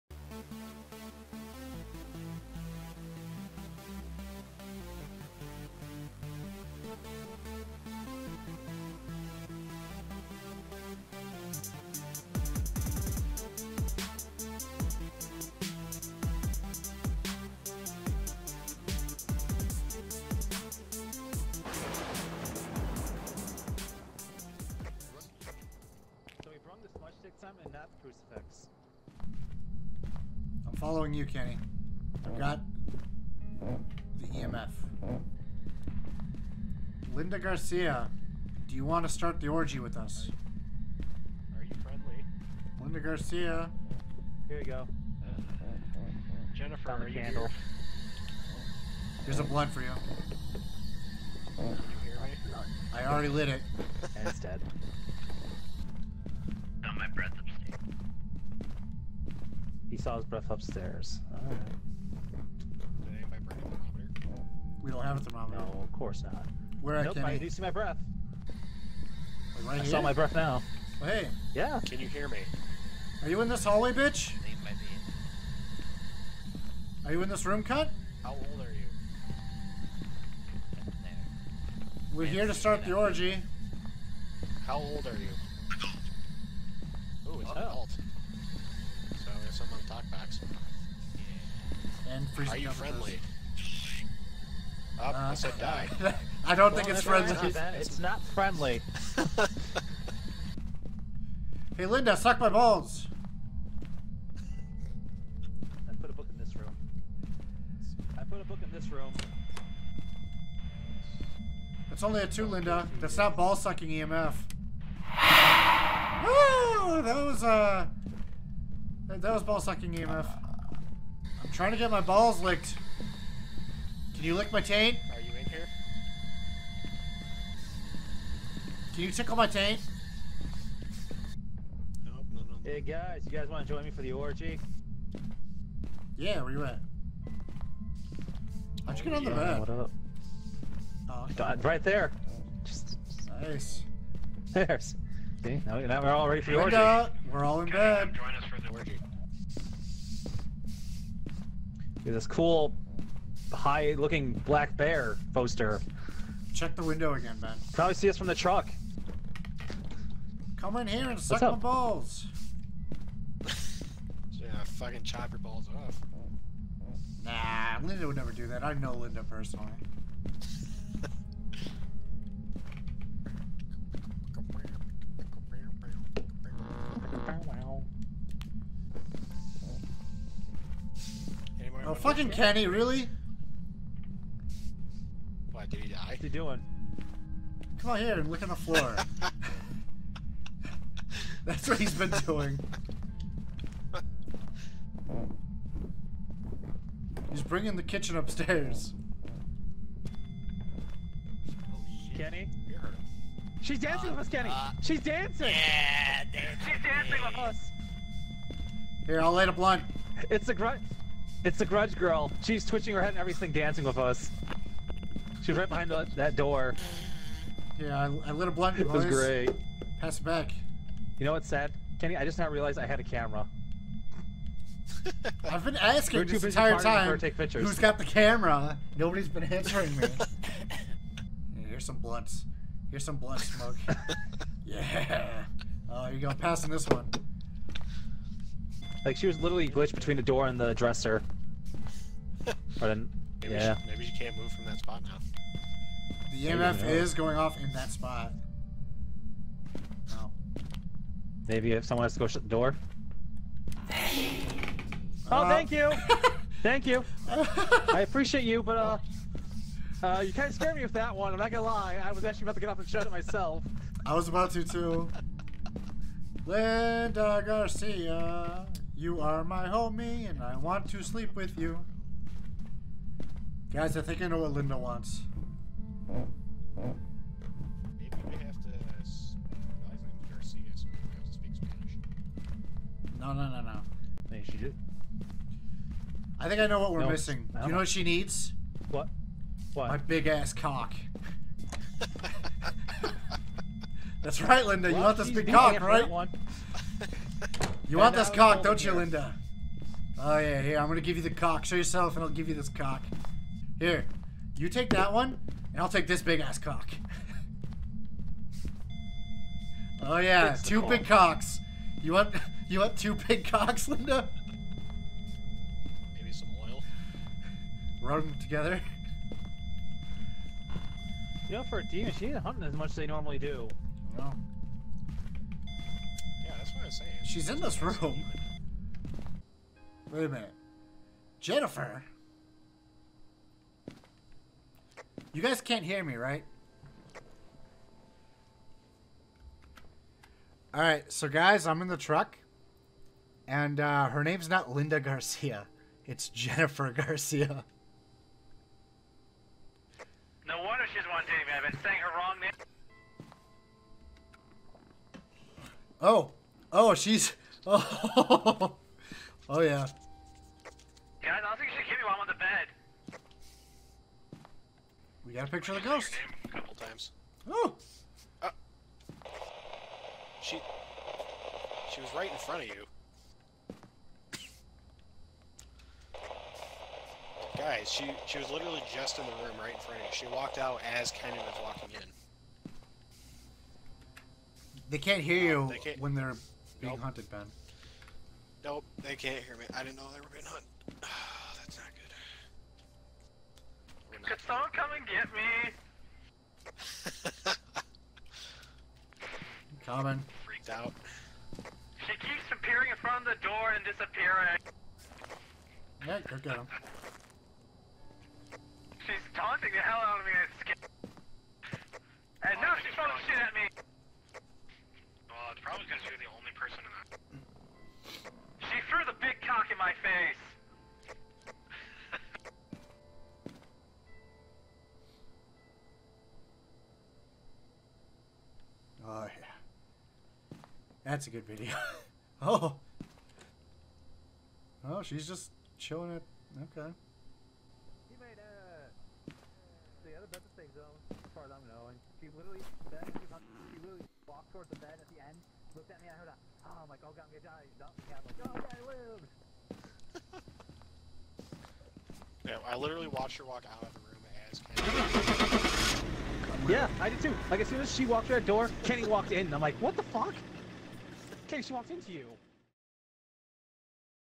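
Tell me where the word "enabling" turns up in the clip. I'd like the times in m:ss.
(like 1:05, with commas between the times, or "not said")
not said.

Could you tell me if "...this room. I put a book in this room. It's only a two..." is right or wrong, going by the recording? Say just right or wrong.
right.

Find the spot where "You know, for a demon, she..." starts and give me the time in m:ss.
5:21.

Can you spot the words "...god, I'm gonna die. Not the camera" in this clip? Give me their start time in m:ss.
7:27.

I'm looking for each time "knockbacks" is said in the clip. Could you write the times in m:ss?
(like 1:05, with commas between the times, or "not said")
1:30.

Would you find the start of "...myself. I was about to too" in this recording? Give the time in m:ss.
4:23.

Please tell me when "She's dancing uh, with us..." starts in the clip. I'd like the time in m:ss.
3:23.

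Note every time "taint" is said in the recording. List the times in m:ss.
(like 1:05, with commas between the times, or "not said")
2:04, 2:09.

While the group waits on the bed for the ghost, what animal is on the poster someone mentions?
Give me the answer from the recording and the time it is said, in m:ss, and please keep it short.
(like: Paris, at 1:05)
Black bear, at 2:34.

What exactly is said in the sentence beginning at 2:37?
Probably see us from the truck.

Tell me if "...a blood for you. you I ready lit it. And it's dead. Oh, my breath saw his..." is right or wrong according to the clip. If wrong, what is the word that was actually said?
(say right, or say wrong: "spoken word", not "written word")
wrong: "already", not "ready".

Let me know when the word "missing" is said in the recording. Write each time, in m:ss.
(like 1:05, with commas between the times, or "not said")
4:47.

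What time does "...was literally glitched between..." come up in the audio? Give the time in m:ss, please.
3:59.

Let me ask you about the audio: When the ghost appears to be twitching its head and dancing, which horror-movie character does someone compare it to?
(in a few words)
The Grudge Girl.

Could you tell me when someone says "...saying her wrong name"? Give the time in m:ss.
5:51.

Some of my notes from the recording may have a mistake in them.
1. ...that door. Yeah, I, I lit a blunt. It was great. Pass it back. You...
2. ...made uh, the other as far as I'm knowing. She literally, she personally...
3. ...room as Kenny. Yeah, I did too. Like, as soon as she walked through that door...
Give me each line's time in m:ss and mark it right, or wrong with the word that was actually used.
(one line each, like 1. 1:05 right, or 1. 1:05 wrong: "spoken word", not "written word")
1. 3:36 right
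2. 7:18 wrong: "literally", not "personally"
3. 7:34 right.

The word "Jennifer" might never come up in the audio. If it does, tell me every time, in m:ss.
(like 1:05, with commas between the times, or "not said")
0:46, 5:31, 5:46.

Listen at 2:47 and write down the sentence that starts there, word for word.
Nah, Linda would never do that.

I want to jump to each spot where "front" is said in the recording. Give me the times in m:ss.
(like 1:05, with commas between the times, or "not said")
6:12, 6:19, 6:42.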